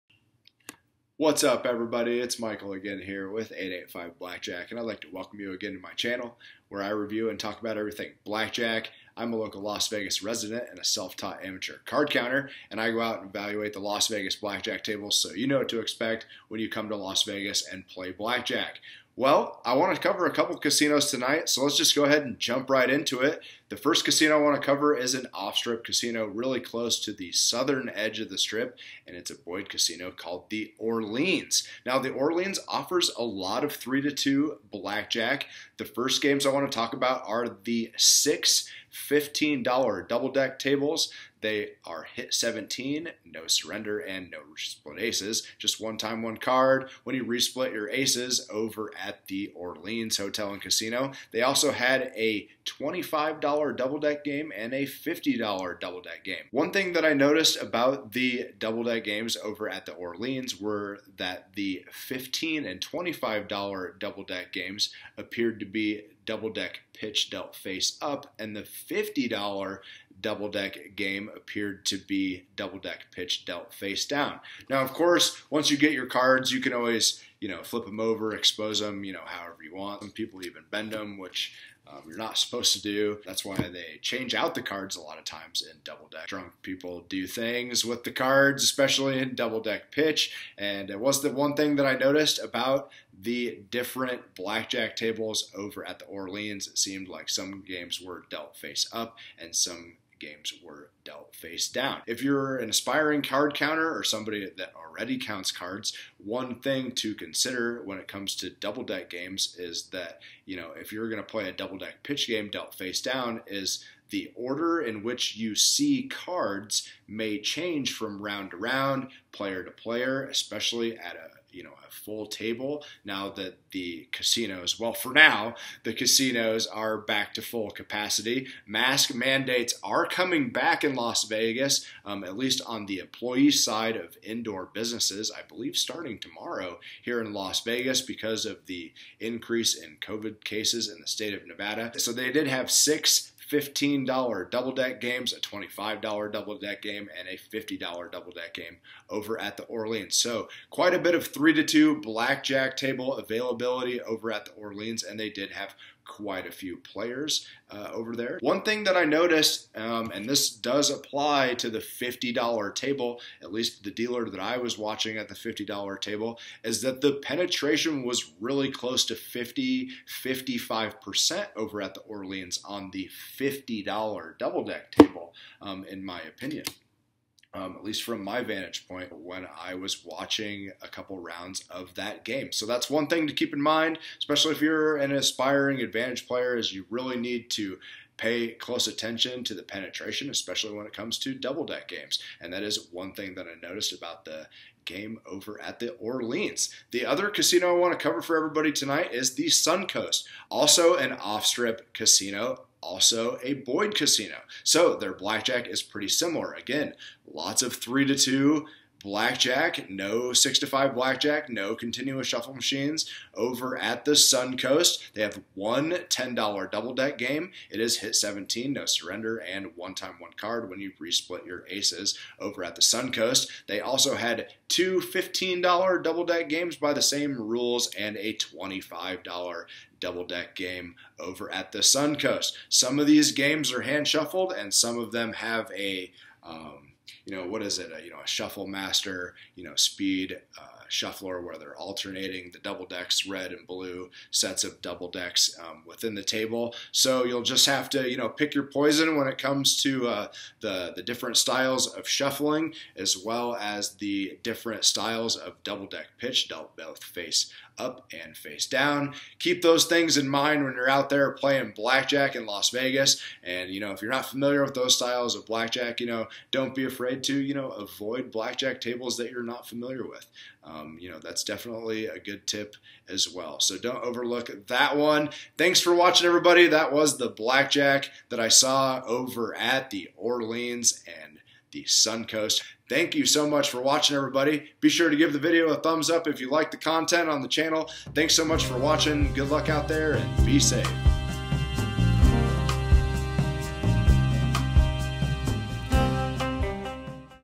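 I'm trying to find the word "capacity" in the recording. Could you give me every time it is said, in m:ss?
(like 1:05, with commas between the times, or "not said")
2:07.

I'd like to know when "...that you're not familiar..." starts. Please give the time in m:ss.
4:29.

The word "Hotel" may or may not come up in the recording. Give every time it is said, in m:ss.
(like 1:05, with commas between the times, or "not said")
0:50.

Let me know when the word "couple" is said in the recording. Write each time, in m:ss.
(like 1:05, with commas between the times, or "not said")
0:20, 3:00.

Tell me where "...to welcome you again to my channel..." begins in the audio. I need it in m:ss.
0:05.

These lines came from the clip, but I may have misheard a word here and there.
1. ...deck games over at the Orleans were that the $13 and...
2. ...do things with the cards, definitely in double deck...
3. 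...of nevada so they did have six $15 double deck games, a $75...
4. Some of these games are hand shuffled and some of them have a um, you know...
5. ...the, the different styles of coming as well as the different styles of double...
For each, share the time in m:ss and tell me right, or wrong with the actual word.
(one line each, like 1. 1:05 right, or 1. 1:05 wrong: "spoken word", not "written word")
1. 0:58 wrong: "15", not "13"
2. 1:27 wrong: "especially", not "definitely"
3. 2:21 wrong: "25", not "75"
4. 3:52 right
5. 4:10 wrong: "shuffling", not "coming".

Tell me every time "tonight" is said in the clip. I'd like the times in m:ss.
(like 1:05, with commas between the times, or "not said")
0:21, 3:18.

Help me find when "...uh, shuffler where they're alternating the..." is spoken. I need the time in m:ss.
4:00.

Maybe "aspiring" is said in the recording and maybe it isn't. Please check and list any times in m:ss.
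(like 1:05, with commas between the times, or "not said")
1:42, 3:05.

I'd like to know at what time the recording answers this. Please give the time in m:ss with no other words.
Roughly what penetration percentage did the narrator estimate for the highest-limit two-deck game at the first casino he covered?
2:49.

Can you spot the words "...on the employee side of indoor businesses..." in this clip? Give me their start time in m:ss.
2:12.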